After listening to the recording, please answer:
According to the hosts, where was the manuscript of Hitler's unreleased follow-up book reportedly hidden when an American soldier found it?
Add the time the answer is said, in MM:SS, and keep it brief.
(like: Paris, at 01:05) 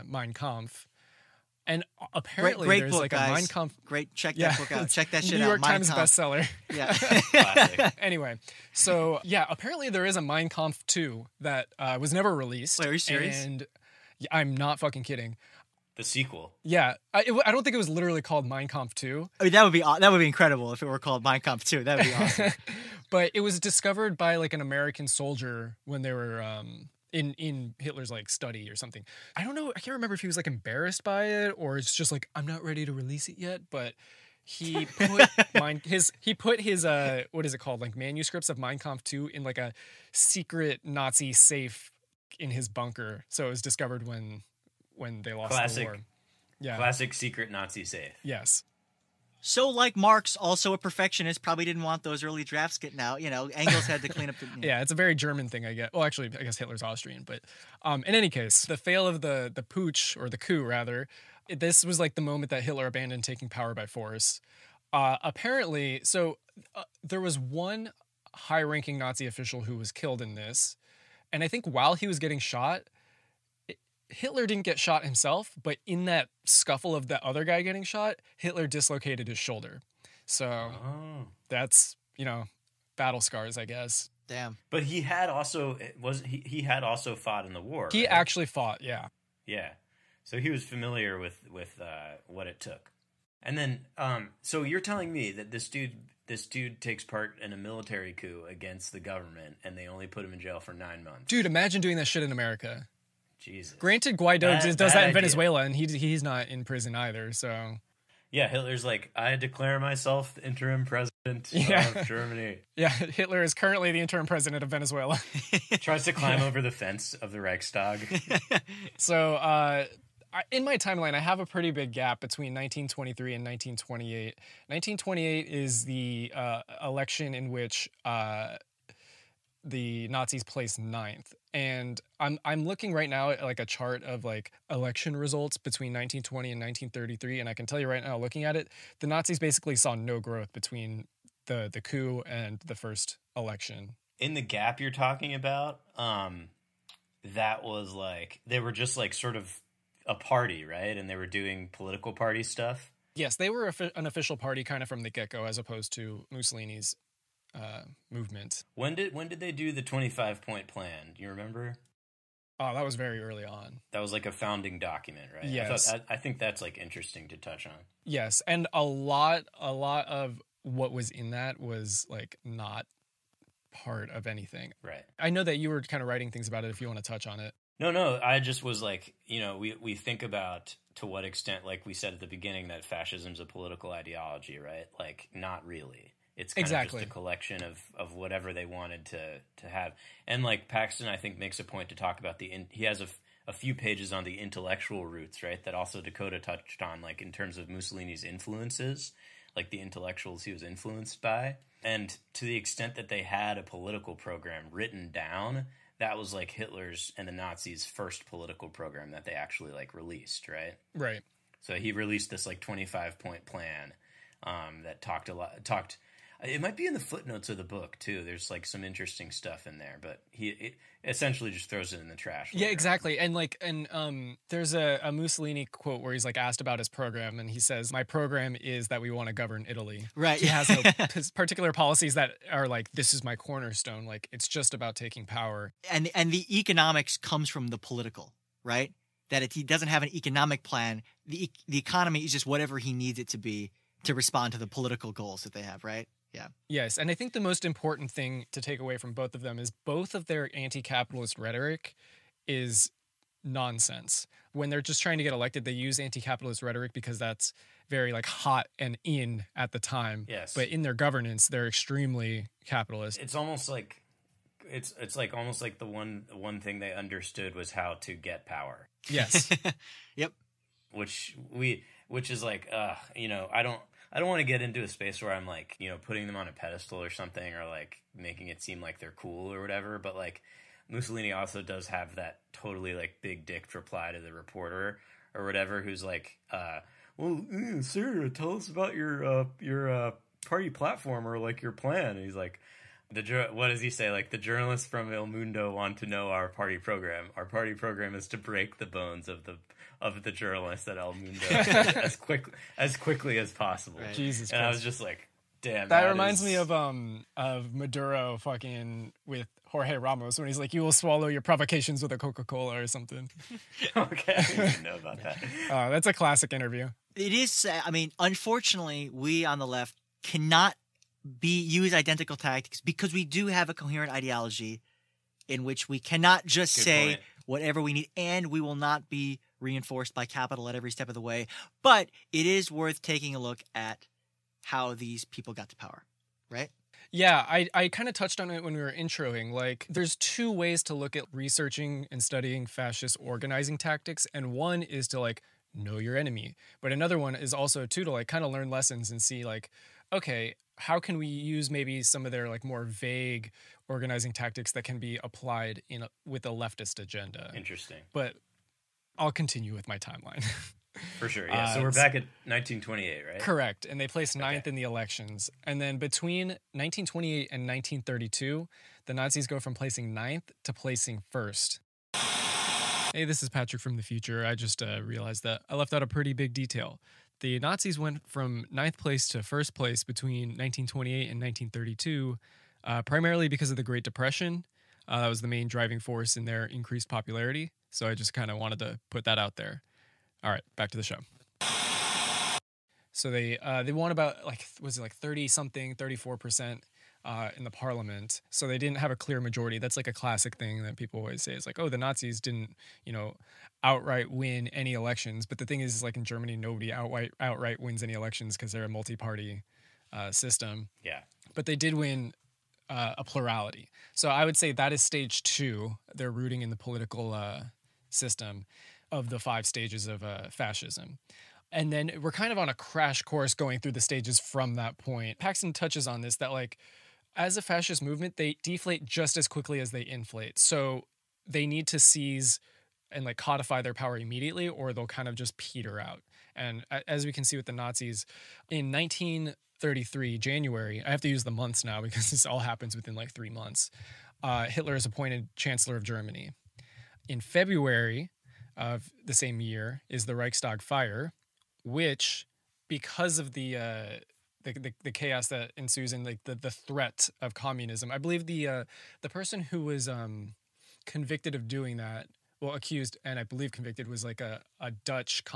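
secret Nazi safe in his bunker, at 00:40.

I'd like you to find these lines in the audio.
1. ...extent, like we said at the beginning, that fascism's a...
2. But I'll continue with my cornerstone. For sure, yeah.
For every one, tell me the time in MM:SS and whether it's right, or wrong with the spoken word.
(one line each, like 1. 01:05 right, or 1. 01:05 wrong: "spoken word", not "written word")
1. 03:01 right
2. 05:58 wrong: "timeline", not "cornerstone".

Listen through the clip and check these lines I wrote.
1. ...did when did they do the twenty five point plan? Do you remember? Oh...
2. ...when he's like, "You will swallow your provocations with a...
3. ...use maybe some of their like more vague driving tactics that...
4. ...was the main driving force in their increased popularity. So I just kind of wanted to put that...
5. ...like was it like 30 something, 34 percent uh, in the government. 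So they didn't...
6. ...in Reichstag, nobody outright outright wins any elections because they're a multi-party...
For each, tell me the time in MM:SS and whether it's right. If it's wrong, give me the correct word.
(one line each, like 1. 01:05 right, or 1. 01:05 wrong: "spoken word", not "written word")
1. 02:38 right
2. 05:10 right
3. 05:51 wrong: "organizing", not "driving"
4. 06:25 right
5. 06:34 wrong: "parliament", not "government"
6. 06:46 wrong: "Germany", not "Reichstag".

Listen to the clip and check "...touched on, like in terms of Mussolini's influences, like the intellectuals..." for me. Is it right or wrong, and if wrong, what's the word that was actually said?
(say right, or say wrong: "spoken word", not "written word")
right.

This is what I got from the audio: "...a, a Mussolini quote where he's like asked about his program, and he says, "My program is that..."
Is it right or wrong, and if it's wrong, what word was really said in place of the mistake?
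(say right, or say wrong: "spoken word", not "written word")
right.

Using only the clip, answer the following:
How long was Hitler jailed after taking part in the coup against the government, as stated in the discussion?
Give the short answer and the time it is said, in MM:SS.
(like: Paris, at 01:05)
9 months, at 01:40.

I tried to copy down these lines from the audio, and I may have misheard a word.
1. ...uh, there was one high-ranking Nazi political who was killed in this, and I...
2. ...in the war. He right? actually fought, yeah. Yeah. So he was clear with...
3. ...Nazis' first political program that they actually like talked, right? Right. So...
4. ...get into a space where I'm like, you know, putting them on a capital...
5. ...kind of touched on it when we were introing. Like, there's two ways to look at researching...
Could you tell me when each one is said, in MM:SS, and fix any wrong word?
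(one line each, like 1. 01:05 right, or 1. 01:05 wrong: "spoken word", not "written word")
1. 01:06 wrong: "official", not "political"
2. 01:27 wrong: "familiar", not "clear"
3. 03:27 wrong: "released", not "talked"
4. 04:34 wrong: "pedestal", not "capital"
5. 05:37 right.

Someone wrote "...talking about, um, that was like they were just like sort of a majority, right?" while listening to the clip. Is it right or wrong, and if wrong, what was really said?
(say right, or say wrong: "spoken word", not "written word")
wrong: "party", not "majority".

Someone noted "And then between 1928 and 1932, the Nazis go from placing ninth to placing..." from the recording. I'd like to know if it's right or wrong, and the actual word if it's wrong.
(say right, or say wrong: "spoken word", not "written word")
right.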